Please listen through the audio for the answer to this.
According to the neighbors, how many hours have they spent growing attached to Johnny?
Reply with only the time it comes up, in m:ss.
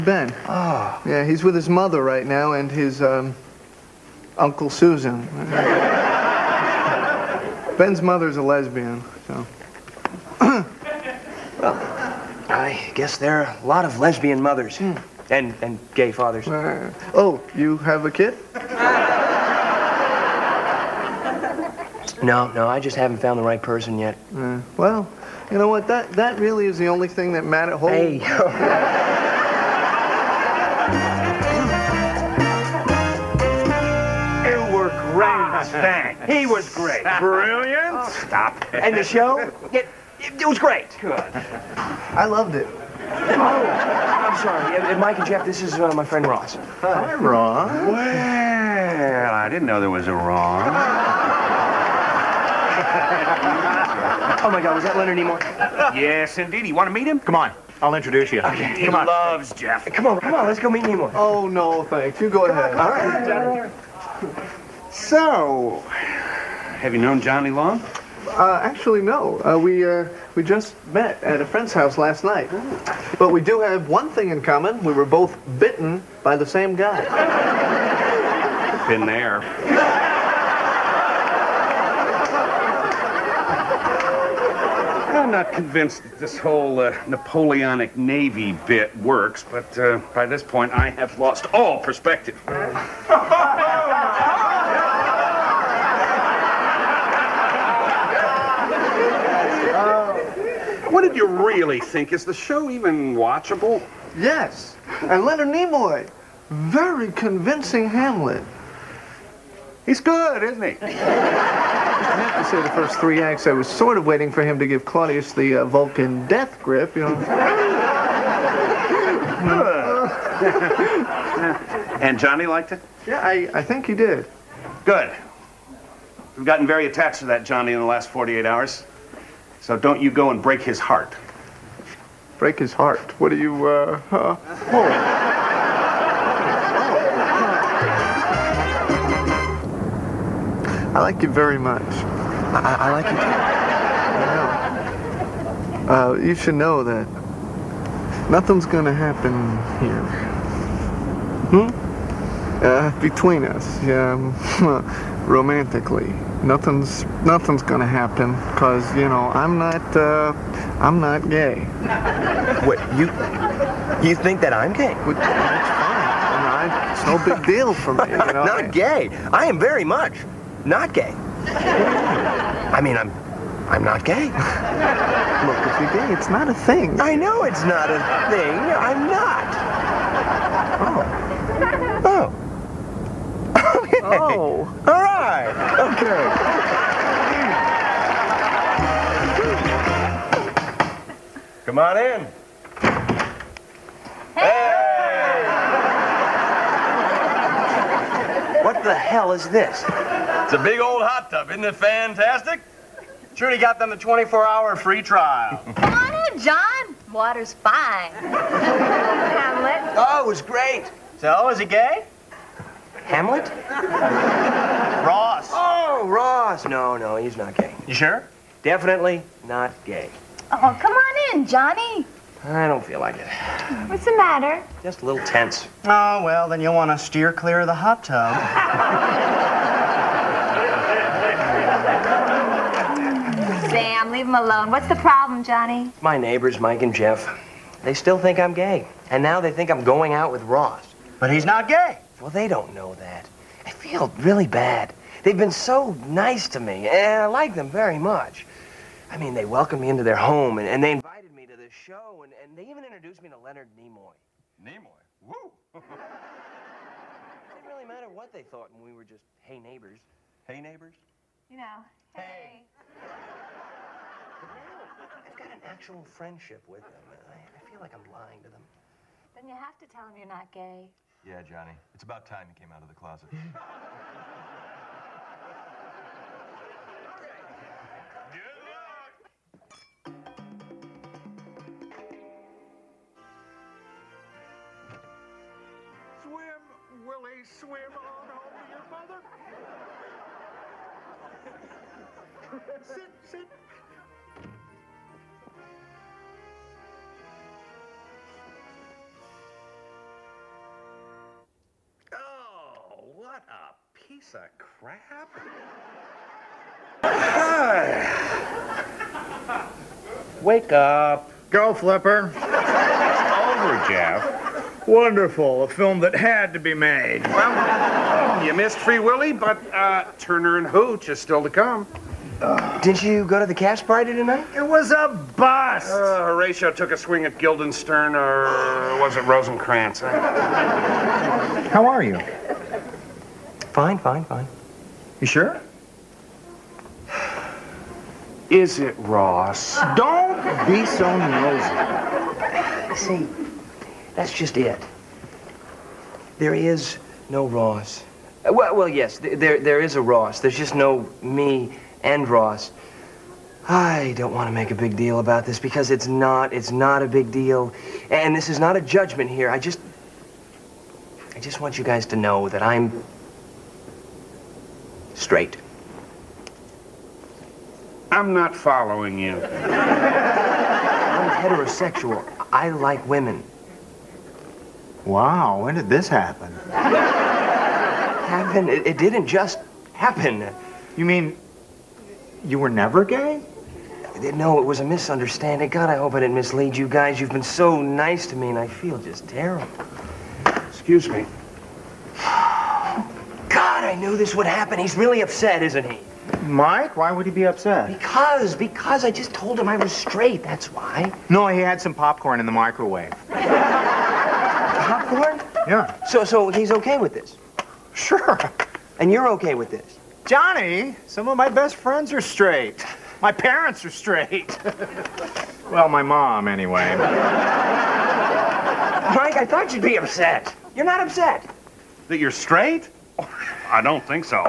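2:08.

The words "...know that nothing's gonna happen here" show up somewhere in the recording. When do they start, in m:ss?
2:26.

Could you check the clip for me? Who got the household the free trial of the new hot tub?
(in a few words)
Trudy.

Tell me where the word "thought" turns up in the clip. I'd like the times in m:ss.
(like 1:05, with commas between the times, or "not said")
4:18, 6:59.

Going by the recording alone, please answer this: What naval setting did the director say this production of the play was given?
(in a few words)
Napoleonic Navy.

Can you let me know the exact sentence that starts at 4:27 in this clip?
I, I feel like I'm lying to them.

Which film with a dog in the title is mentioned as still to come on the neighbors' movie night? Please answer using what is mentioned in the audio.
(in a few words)
Turner and Hooch.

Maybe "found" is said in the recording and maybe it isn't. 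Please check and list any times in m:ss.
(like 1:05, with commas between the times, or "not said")
0:23.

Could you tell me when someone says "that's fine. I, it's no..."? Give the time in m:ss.
2:44.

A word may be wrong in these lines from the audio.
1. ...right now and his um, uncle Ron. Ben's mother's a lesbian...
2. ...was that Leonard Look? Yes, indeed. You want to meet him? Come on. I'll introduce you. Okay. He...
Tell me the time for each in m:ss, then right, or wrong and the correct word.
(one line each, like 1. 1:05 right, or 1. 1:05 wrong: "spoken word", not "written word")
1. 0:02 wrong: "Susan", not "Ron"
2. 0:54 wrong: "Nimoy", not "Look".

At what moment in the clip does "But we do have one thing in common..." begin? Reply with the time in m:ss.
1:13.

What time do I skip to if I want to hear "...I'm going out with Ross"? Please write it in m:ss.
3:59.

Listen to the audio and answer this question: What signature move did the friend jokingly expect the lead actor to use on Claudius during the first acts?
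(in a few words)
Vulcan death grip.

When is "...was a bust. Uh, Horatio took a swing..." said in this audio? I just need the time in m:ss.
5:24.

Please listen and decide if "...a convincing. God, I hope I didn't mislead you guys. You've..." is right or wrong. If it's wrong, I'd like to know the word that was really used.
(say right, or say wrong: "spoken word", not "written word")
wrong: "misunderstanding", not "convincing".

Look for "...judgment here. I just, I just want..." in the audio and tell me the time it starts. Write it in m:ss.
5:58.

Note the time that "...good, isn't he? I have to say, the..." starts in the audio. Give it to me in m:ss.
1:49.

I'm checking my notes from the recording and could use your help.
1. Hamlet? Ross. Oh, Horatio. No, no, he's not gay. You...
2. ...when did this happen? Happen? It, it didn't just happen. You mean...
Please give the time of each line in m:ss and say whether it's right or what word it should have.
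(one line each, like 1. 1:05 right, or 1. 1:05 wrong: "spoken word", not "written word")
1. 3:33 wrong: "Ross", not "Horatio"
2. 6:15 right.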